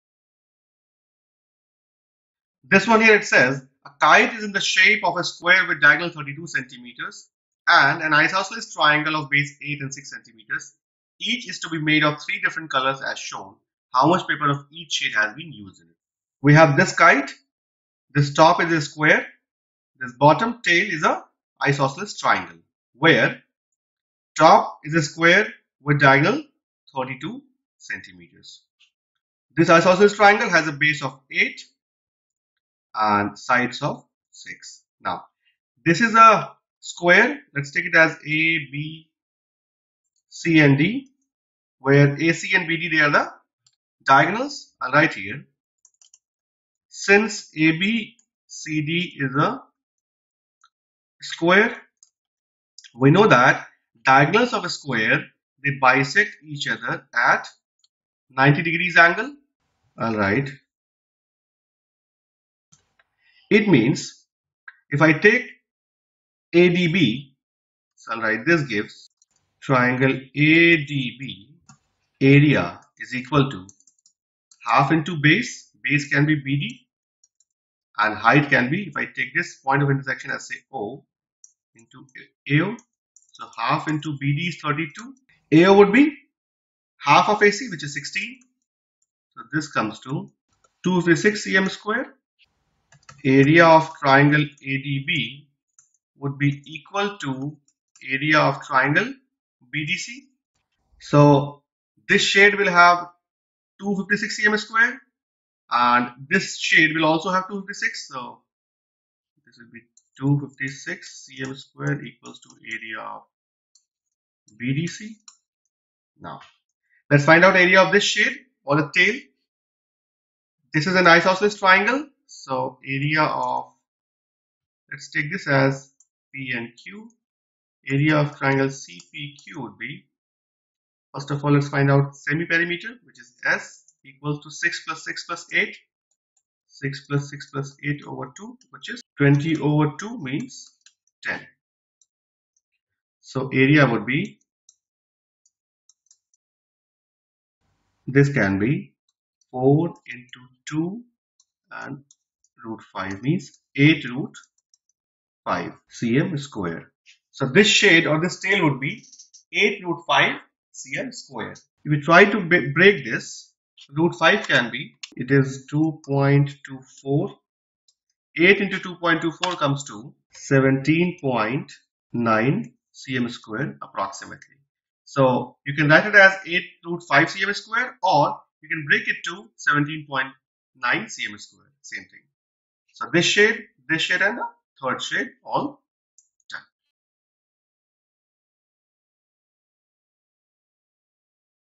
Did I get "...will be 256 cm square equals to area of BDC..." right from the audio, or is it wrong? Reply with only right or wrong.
right.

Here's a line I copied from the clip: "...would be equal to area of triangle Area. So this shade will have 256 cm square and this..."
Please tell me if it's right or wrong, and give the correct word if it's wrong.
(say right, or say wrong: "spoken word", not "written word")
wrong: "BDC", not "Area".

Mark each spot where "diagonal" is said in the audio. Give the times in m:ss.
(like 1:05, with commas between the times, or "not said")
0:05, 0:25, 0:44, 0:54.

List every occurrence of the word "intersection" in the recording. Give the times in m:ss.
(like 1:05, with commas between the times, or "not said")
1:19.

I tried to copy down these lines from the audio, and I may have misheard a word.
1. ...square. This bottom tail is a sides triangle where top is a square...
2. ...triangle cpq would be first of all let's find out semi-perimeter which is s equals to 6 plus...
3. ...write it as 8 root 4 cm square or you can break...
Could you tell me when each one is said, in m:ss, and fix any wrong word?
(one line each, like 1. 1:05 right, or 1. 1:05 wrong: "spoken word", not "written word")
1. 0:18 wrong: "isosceles", not "sides"
2. 2:08 right
3. 2:55 wrong: "5", not "4".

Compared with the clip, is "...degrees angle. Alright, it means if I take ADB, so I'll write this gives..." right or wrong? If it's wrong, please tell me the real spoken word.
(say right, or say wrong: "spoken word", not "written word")
right.